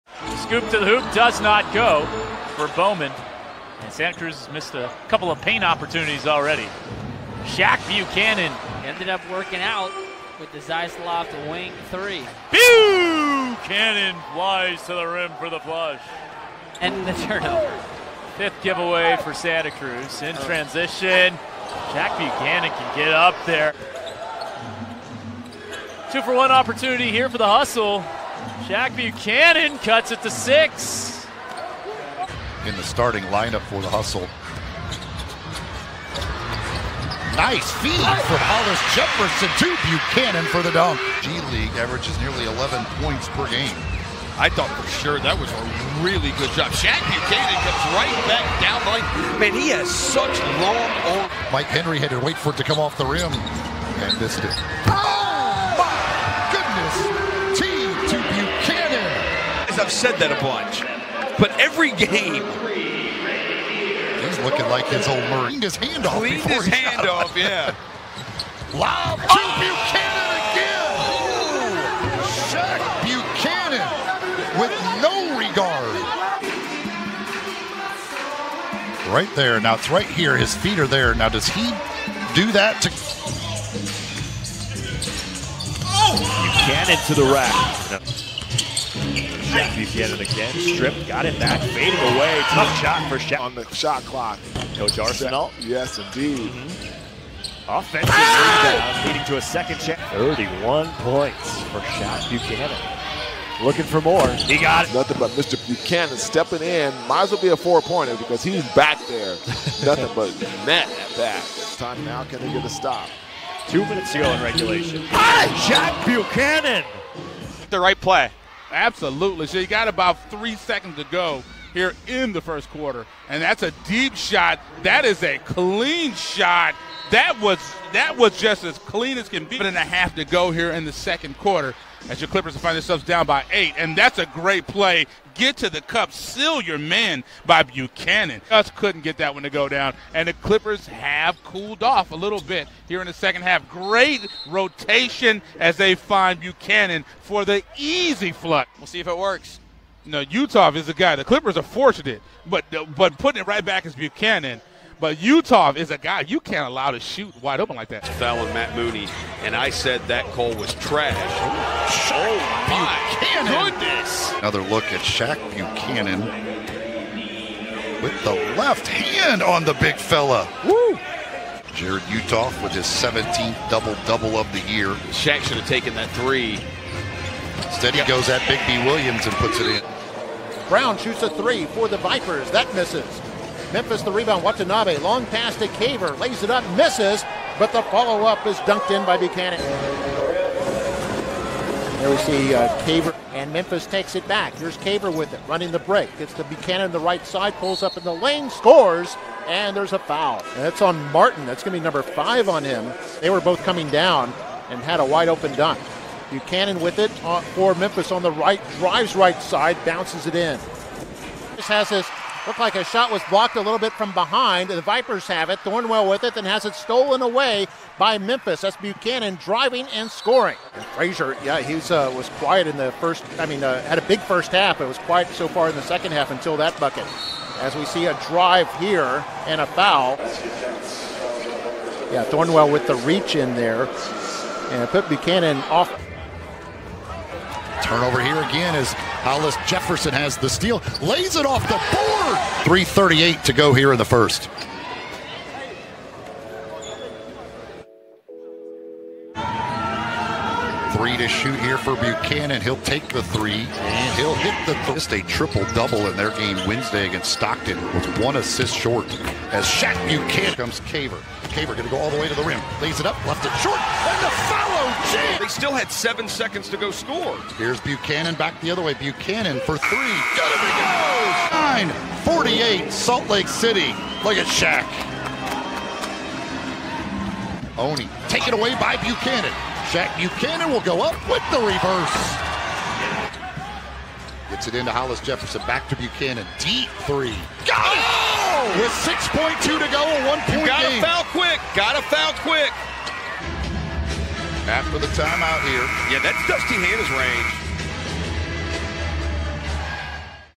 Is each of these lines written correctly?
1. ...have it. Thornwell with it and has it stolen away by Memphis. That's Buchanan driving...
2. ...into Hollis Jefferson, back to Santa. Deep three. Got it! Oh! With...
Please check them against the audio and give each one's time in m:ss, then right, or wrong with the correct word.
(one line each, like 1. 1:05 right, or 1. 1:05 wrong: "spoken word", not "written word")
1. 3:35 right
2. 4:44 wrong: "Buchanan", not "Santa".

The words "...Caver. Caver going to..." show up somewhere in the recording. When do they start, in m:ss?
4:20.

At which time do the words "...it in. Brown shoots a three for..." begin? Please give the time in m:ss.
2:59.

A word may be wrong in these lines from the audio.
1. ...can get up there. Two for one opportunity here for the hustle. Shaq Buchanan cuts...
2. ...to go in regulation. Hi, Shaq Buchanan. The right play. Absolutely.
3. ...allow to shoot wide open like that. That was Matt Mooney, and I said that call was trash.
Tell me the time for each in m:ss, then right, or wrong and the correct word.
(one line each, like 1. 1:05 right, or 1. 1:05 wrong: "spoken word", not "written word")
1. 0:22 right
2. 1:54 right
3. 2:36 right.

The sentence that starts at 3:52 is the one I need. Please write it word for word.
Yeah, Thornwell with the reach in there.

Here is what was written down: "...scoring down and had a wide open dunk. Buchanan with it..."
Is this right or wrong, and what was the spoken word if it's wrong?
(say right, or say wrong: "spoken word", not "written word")
wrong: "coming", not "scoring".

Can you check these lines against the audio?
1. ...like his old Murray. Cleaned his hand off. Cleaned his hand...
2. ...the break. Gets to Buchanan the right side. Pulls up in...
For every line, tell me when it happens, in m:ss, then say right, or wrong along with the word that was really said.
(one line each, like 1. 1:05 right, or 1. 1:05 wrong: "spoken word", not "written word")
1. 1:04 right
2. 3:15 right.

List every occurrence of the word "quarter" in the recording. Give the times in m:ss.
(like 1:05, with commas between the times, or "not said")
2:02, 2:11.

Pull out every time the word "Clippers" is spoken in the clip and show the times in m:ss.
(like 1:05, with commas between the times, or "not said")
2:12, 2:20, 2:31.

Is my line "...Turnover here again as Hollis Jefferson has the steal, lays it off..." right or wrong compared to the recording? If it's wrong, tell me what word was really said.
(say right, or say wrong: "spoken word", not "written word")
right.